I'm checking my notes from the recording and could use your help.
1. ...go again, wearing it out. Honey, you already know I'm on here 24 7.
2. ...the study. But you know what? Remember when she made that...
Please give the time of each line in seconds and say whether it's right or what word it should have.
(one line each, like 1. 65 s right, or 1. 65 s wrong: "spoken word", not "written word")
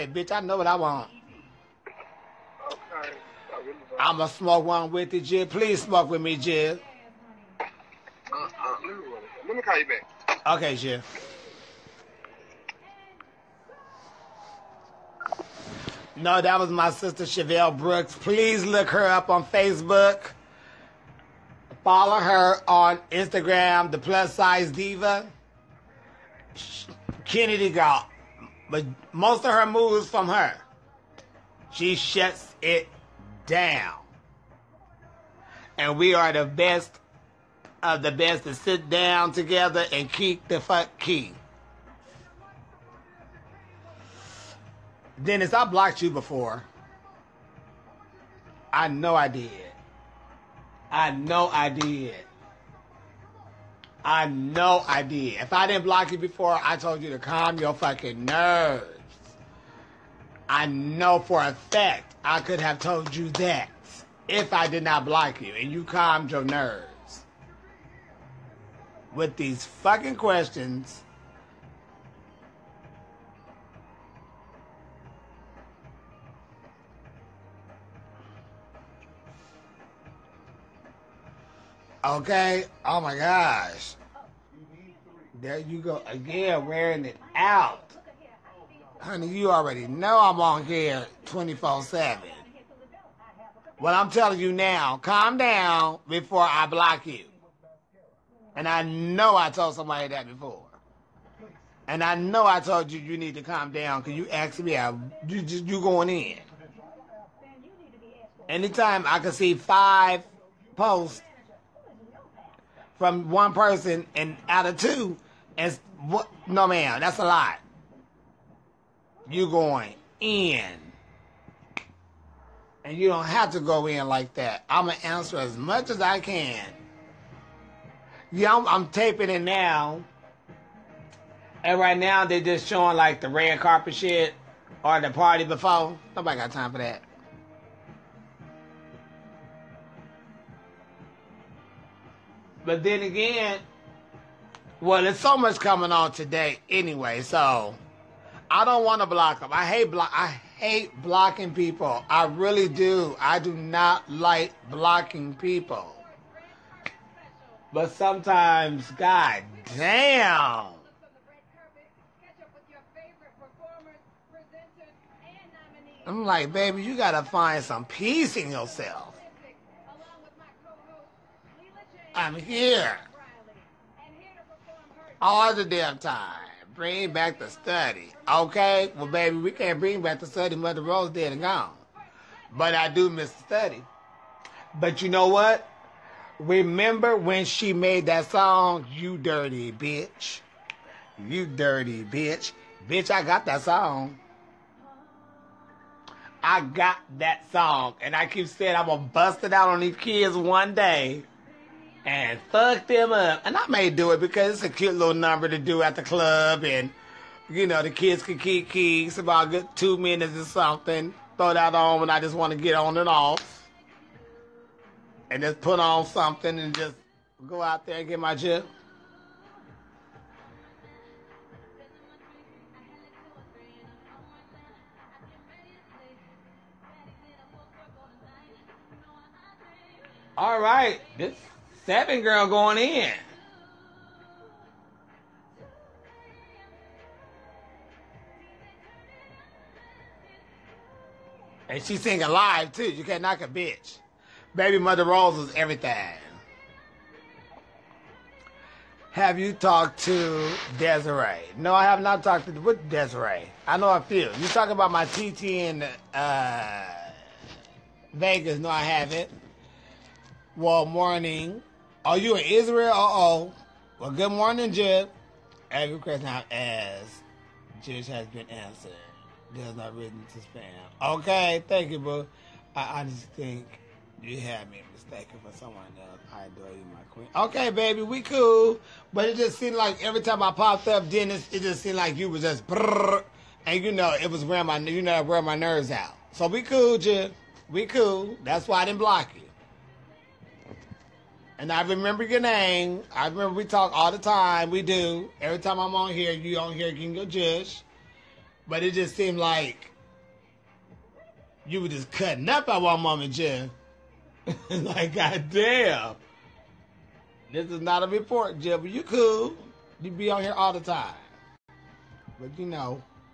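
1. 85 s right
2. 183 s right.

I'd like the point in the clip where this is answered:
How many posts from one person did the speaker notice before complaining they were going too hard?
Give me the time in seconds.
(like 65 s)
109 s.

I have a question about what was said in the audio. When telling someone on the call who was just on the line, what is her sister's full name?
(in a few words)
Chevelle Brooks.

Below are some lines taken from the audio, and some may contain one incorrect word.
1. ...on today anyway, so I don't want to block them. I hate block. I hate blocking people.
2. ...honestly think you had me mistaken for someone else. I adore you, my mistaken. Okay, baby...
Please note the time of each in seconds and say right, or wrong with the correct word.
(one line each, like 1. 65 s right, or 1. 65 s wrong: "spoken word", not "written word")
1. 145 s right
2. 272 s wrong: "queen", not "mistaken".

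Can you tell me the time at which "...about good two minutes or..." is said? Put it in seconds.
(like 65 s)
209 s.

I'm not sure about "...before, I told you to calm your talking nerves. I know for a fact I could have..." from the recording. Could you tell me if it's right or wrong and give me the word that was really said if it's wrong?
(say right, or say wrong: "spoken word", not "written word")
wrong: "fucking", not "talking".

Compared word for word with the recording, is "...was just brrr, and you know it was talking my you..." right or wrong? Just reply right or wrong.
wrong.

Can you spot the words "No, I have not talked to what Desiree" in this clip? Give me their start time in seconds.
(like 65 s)
251 s.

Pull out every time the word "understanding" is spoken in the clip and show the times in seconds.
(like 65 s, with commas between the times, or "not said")
not said.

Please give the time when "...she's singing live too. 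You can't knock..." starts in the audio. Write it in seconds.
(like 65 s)
241 s.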